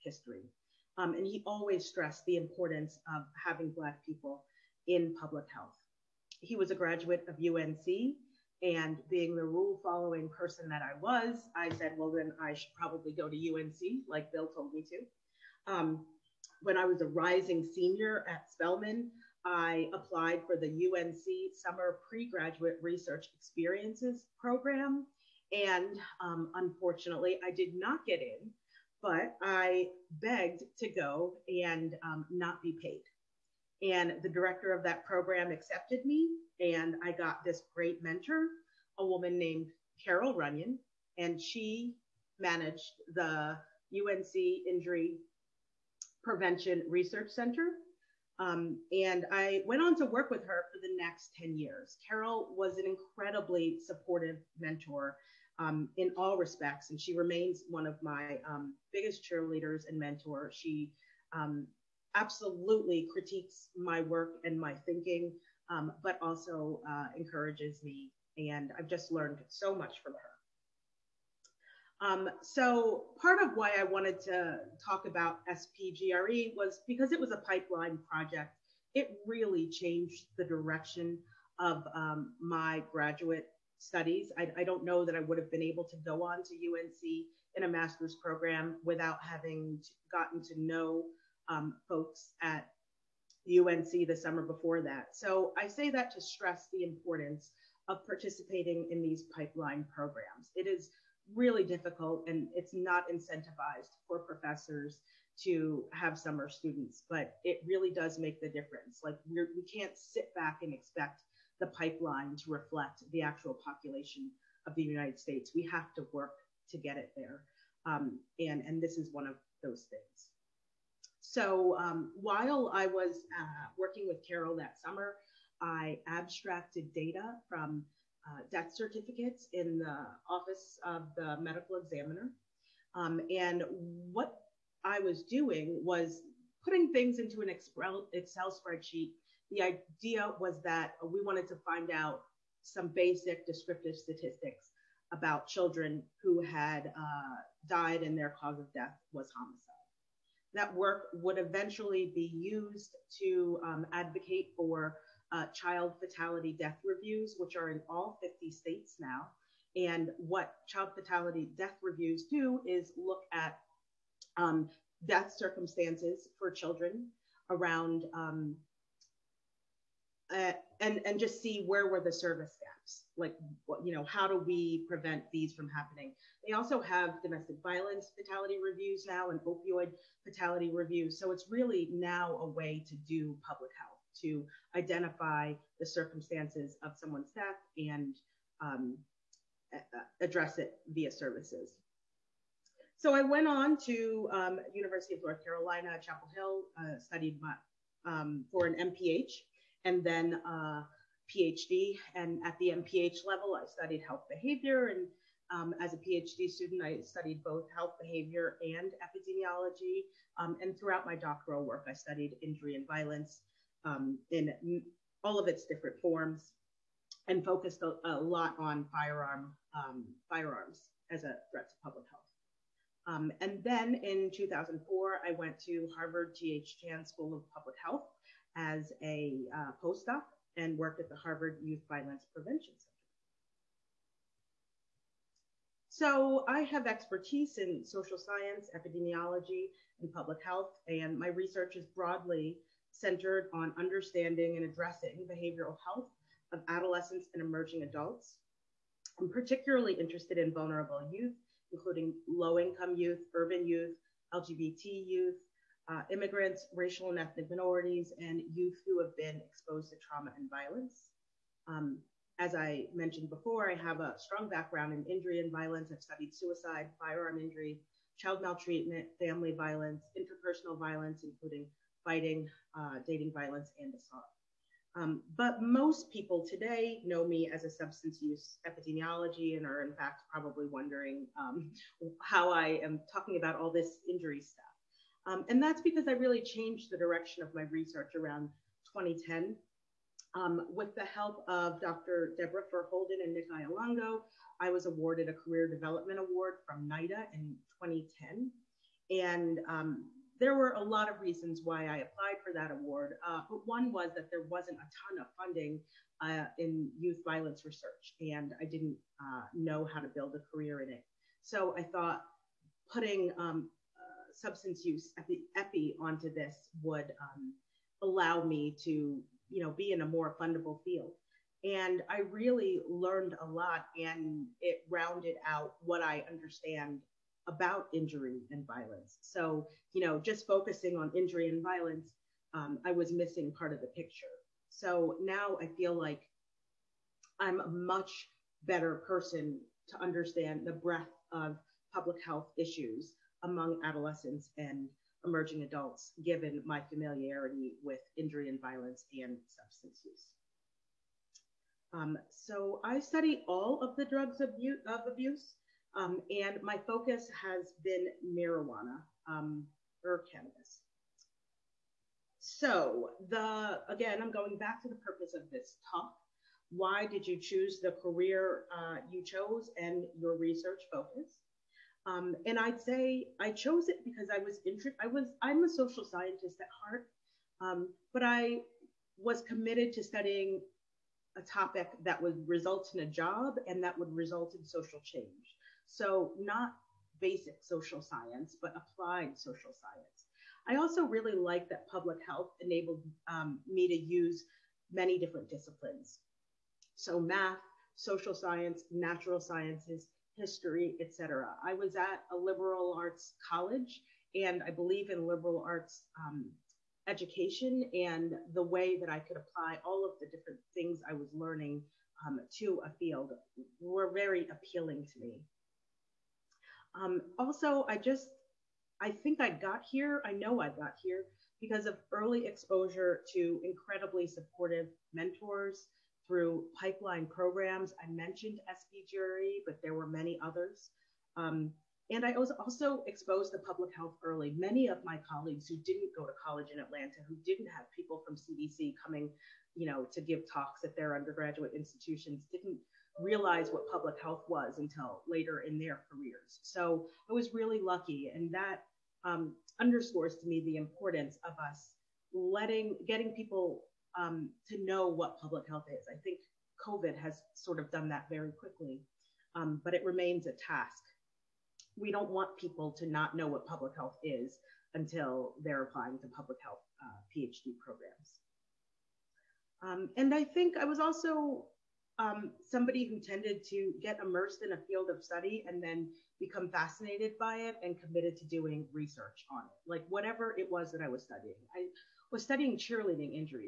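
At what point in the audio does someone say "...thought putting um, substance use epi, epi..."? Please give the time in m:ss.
5:11.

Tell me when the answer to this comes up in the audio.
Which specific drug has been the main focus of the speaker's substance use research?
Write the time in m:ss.
5:58.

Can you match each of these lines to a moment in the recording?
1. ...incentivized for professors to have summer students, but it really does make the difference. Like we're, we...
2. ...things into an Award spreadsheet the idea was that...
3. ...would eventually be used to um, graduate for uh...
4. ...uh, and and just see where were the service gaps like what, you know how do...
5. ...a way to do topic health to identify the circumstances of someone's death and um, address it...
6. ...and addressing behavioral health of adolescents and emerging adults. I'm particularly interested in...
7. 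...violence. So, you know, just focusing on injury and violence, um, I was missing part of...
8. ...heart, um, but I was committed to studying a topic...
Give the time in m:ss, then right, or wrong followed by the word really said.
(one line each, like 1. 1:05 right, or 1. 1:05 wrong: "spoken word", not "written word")
1. 1:43 right
2. 2:16 wrong: "Excel", not "Award"
3. 2:31 wrong: "advocate", not "graduate"
4. 2:50 right
5. 3:02 wrong: "public", not "topic"
6. 4:04 right
7. 5:28 right
8. 6:16 right.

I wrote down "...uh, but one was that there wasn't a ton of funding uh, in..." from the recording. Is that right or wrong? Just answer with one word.
right.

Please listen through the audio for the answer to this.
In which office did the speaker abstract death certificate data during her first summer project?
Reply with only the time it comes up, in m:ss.
2:10.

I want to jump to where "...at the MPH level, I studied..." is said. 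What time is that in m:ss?
3:22.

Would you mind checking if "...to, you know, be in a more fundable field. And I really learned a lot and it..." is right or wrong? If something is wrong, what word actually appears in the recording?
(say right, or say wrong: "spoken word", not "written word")
right.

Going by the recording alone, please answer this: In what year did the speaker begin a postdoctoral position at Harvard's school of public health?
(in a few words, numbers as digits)
2004.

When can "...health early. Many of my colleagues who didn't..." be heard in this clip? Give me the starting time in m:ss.
7:13.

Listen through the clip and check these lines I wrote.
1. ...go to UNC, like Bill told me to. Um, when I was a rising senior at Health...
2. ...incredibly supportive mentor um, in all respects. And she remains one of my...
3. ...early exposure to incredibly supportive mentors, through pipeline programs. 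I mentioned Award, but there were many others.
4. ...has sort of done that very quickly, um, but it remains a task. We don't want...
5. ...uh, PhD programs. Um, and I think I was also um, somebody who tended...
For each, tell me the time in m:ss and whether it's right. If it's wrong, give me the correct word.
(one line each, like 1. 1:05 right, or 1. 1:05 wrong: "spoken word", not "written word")
1. 0:13 wrong: "Spelman", not "Health"
2. 0:52 right
3. 7:02 wrong: "SPGRE", not "Award"
4. 7:37 right
5. 7:47 right.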